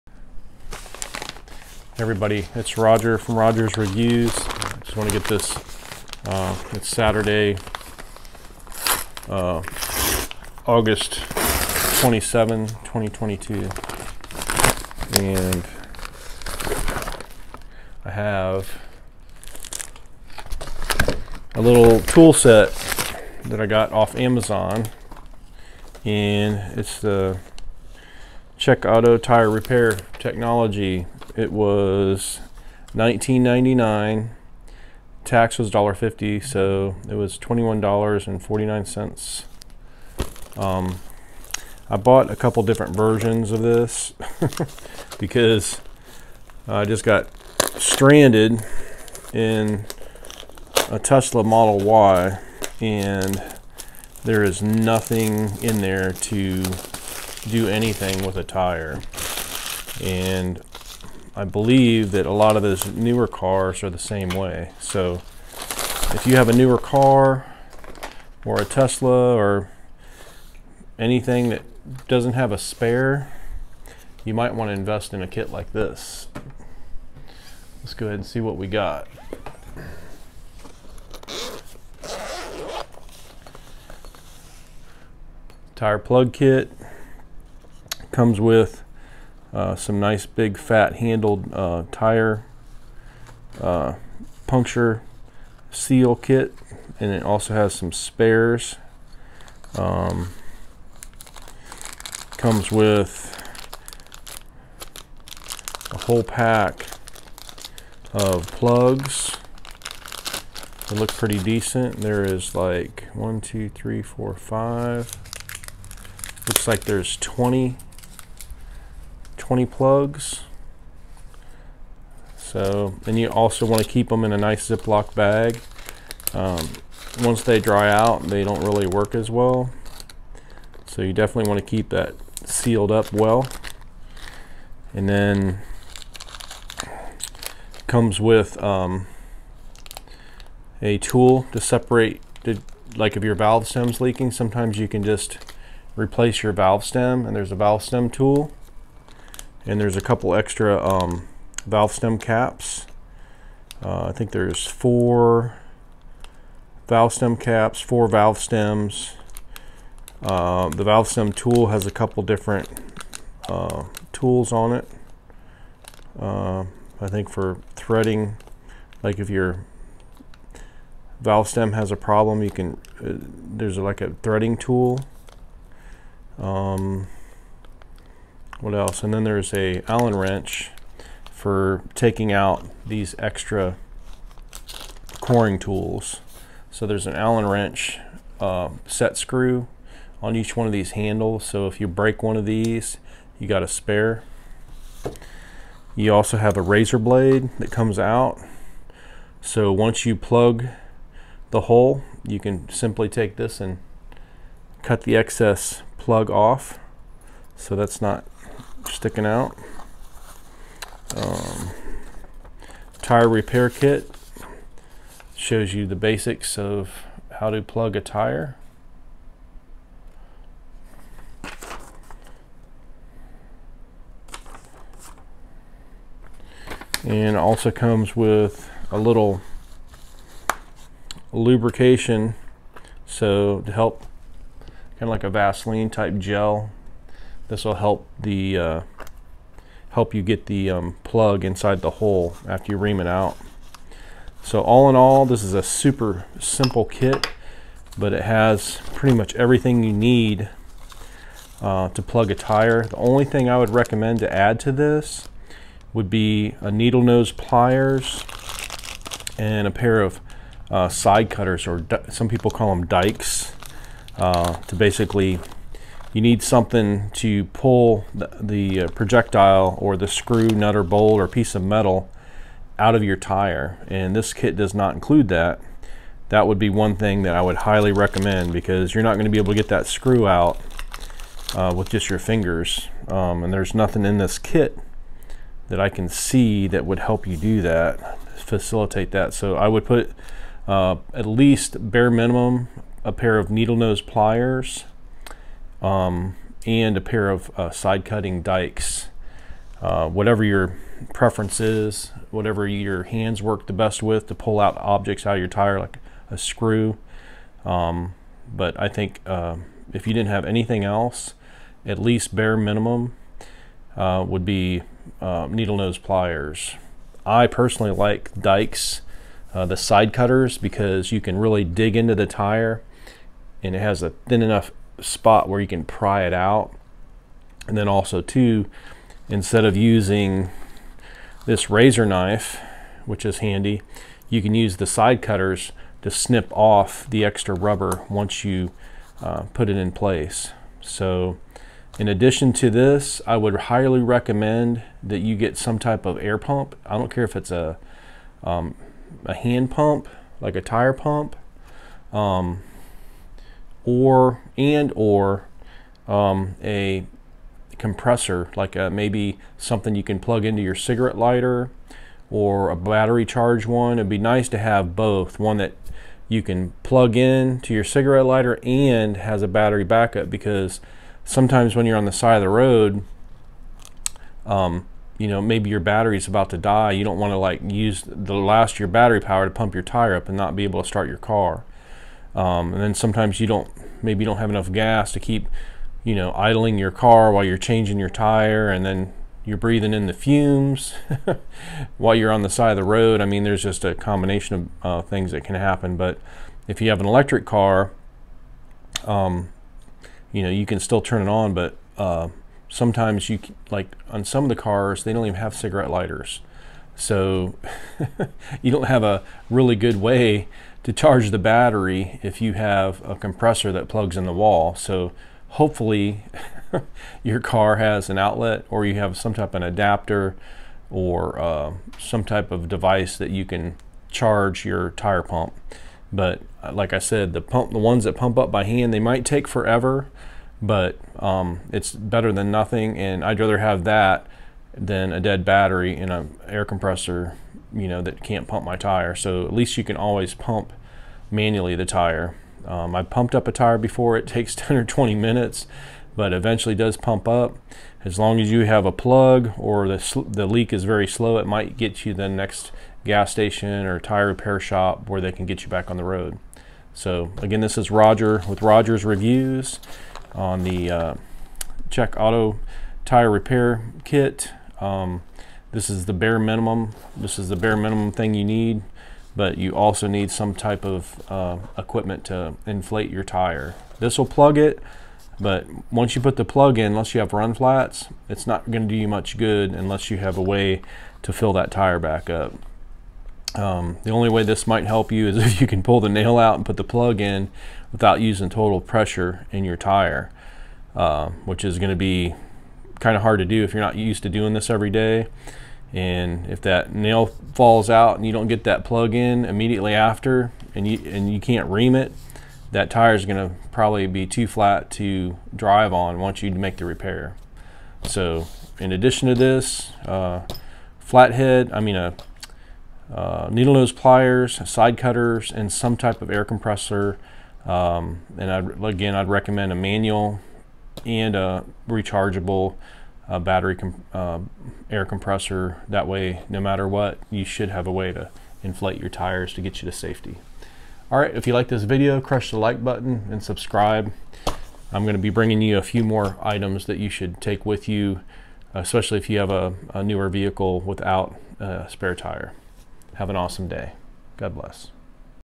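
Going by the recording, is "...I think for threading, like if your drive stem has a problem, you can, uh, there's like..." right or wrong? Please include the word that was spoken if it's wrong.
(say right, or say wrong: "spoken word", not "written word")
wrong: "valve", not "drive".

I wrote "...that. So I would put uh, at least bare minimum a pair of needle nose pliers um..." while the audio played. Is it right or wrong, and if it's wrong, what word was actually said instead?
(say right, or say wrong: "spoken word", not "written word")
right.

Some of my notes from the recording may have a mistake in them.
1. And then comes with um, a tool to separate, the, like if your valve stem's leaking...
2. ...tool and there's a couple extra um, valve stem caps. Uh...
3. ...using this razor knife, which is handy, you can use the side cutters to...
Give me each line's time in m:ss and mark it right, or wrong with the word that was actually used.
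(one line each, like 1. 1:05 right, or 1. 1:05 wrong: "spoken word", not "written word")
1. 2:14 right
2. 2:28 right
3. 5:29 right.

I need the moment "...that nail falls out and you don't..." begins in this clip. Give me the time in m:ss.
8:16.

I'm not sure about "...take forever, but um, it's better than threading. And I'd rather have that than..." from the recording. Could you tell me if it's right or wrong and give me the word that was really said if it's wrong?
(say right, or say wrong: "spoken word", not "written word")
wrong: "nothing", not "threading".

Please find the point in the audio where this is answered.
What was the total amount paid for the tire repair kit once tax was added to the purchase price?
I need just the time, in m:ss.
0:37.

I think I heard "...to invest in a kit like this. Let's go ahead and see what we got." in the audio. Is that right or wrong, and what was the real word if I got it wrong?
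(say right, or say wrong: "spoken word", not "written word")
right.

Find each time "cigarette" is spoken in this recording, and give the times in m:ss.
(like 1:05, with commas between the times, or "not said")
6:00, 6:07, 6:45.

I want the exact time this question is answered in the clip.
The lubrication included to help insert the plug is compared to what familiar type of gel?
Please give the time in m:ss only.
3:55.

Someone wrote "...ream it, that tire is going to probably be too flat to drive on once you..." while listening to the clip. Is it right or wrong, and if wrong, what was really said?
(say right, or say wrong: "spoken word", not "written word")
right.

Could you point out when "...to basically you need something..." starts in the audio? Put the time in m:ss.
4:24.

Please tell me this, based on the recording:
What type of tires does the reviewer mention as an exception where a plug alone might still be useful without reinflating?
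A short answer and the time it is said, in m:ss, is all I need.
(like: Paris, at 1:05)
run flats, at 7:57.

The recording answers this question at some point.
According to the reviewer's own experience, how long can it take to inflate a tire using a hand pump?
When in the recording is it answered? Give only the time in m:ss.
7:24.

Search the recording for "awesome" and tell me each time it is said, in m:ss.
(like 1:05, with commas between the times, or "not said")
9:03.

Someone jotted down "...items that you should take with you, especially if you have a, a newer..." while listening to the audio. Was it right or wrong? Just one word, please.
right.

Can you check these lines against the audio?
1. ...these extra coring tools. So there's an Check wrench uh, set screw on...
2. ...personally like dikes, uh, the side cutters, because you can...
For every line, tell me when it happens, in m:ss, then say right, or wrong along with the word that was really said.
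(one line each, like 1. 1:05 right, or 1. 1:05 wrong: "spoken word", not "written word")
1. 3:02 wrong: "Allen", not "Check"
2. 5:17 right.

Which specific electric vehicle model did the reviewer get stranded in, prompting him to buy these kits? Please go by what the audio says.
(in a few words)
Tesla Model Y.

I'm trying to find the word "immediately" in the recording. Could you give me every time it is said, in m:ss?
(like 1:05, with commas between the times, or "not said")
8:19.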